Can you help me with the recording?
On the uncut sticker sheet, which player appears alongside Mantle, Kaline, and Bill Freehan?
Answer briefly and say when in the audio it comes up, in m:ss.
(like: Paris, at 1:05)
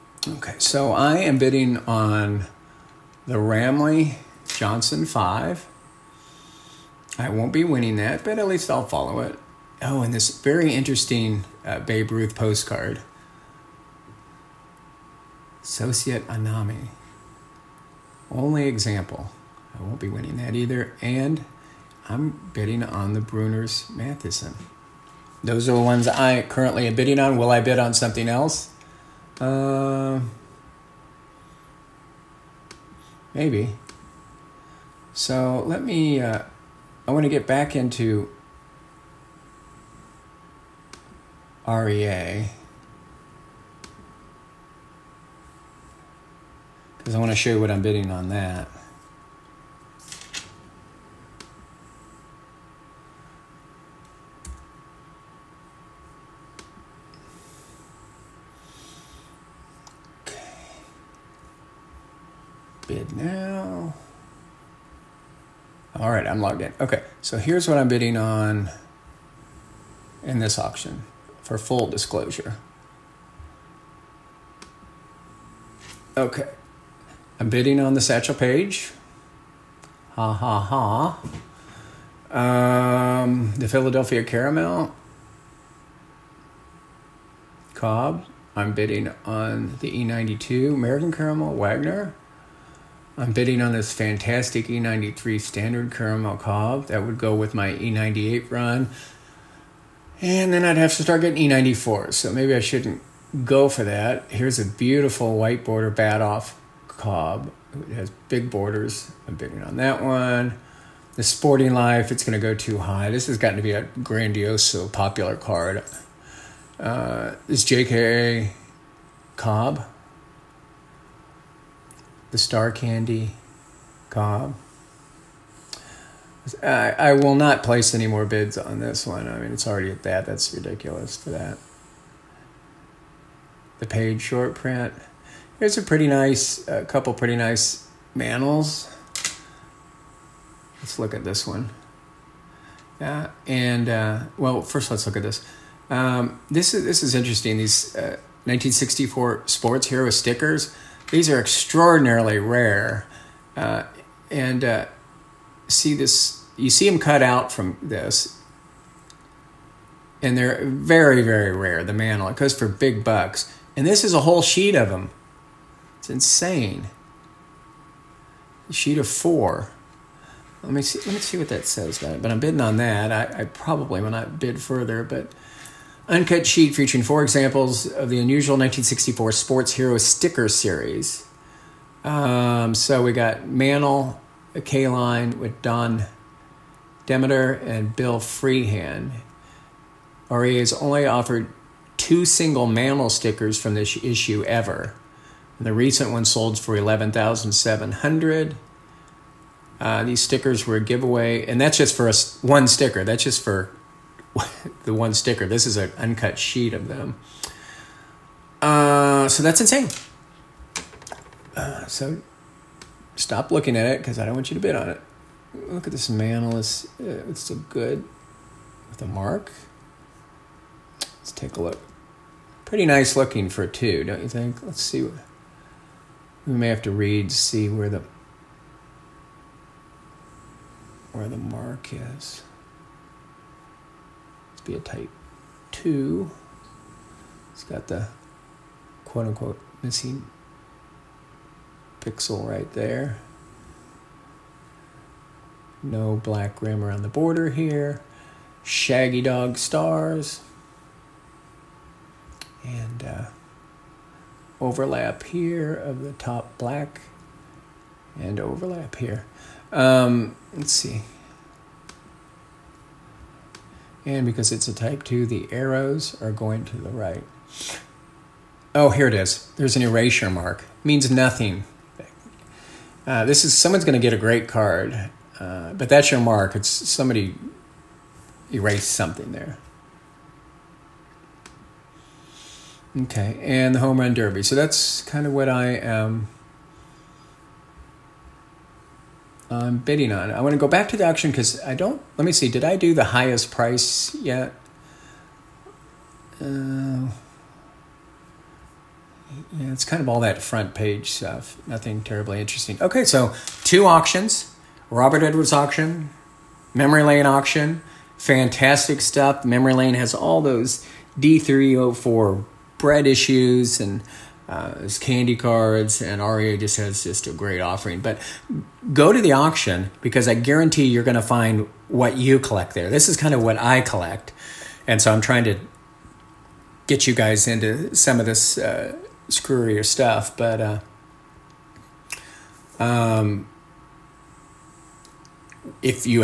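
Don Demeter, at 3:05.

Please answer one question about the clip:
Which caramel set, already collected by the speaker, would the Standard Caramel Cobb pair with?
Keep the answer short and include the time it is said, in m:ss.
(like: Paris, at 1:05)
E98, at 1:37.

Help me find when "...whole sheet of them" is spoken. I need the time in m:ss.
2:44.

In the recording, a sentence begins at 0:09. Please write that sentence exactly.
Oh, and this very interesting uh, Babe Ruth postcard.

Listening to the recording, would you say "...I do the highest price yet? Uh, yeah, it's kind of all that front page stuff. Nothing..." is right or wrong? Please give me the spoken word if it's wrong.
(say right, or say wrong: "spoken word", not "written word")
right.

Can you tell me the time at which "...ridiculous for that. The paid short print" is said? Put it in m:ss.
2:10.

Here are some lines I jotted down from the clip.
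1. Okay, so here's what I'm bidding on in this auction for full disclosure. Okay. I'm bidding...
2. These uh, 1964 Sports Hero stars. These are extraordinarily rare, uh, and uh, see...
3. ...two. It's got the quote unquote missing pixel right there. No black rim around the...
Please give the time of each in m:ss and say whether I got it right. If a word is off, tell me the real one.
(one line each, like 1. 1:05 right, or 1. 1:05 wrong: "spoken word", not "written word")
1. 1:06 right
2. 2:27 wrong: "stickers", not "stars"
3. 3:55 right.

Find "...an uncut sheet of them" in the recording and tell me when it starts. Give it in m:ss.
3:25.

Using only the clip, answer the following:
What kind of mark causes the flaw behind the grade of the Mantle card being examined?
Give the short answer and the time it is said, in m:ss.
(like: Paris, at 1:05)
An erasure mark, at 4:29.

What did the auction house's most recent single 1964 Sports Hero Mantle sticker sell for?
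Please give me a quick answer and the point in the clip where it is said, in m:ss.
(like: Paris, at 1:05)
11700, at 3:16.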